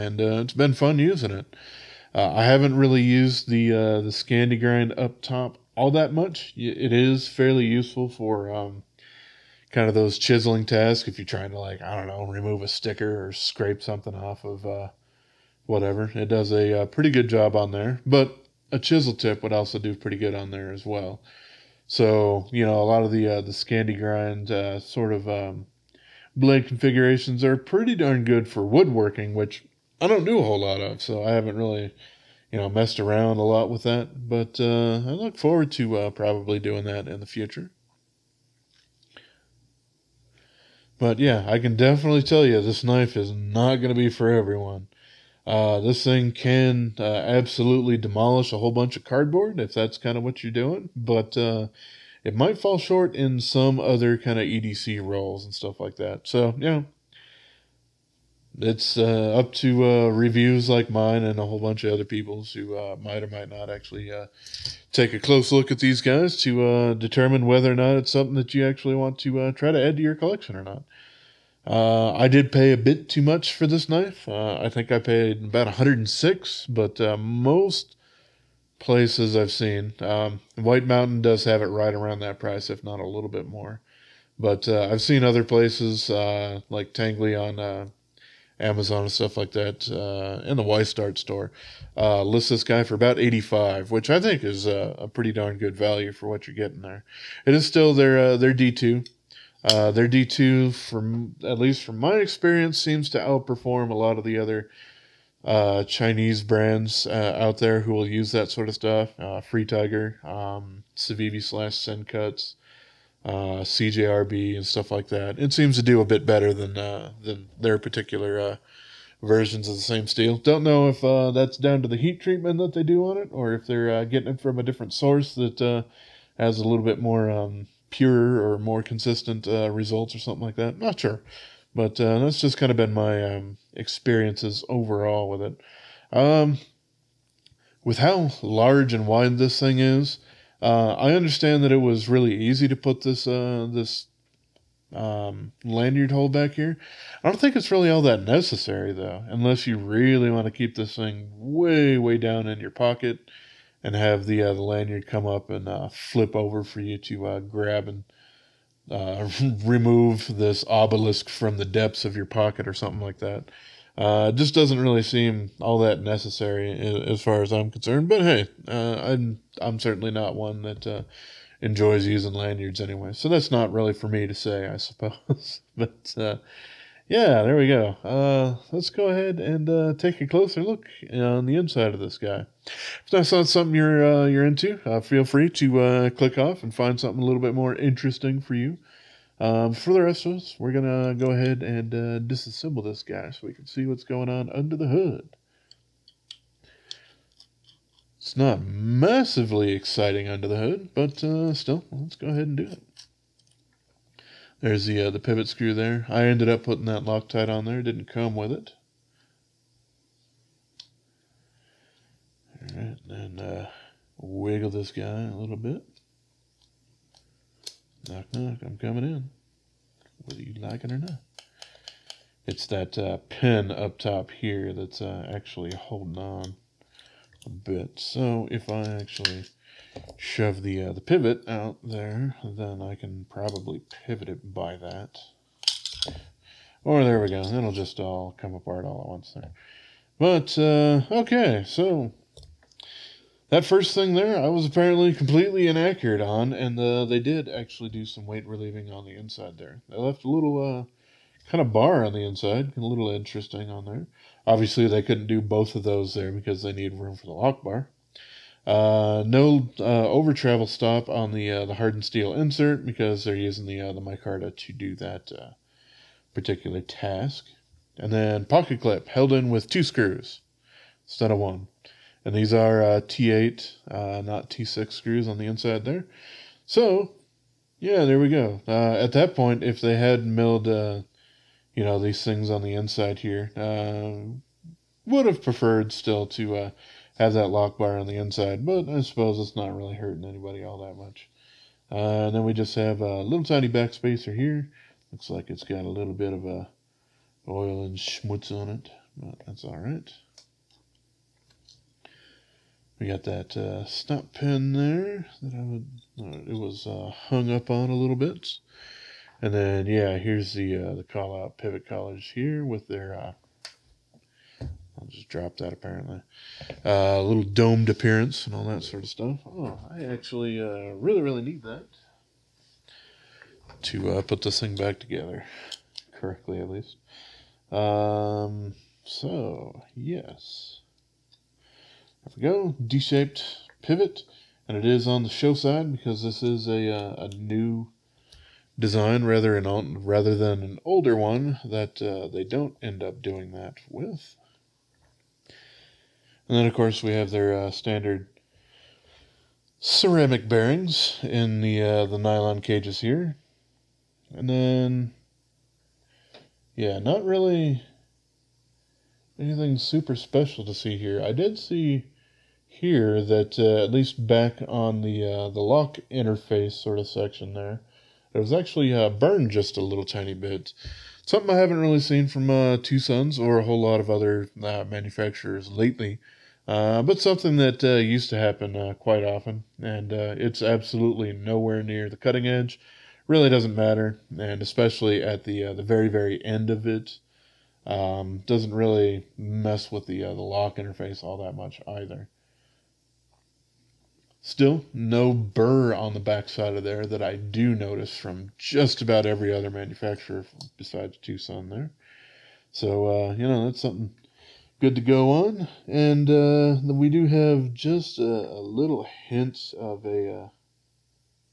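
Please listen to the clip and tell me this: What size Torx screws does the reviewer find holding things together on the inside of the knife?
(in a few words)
T8.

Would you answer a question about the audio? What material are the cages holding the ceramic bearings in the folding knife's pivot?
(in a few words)
nylon.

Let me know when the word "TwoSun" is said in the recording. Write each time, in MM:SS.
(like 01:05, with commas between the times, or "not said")
06:41.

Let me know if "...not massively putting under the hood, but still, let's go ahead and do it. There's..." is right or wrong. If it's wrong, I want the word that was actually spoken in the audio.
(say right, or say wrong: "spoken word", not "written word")
wrong: "exciting", not "putting".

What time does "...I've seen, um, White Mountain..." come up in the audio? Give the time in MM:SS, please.
01:19.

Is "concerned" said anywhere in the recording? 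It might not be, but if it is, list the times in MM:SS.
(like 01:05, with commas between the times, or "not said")
02:47.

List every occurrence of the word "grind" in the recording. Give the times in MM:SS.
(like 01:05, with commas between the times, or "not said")
00:04, 00:23.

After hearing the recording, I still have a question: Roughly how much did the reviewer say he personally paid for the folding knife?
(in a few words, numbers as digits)
106.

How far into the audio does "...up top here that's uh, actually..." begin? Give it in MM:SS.
03:43.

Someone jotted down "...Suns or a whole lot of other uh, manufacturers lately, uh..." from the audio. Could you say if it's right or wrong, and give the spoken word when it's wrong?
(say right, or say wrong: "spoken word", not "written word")
right.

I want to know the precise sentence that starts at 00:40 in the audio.
But yeah, I can definitely tell you this knife is not going to be for everyone.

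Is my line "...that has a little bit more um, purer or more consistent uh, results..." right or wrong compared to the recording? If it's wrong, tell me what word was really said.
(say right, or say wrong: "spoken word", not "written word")
right.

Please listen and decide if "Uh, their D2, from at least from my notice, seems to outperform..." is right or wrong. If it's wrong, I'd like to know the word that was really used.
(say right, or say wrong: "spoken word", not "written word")
wrong: "experience", not "notice".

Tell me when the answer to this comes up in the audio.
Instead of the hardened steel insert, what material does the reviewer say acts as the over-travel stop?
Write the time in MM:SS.
04:24.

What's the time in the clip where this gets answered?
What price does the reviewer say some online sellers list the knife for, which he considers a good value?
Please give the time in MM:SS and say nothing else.
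01:33.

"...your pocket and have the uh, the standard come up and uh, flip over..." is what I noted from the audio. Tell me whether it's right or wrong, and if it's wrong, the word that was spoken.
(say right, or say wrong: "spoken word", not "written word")
wrong: "lanyard", not "standard".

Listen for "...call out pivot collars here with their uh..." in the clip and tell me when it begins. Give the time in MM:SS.
05:11.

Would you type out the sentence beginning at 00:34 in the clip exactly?
But uh, I look forward to uh, probably doing that in the future.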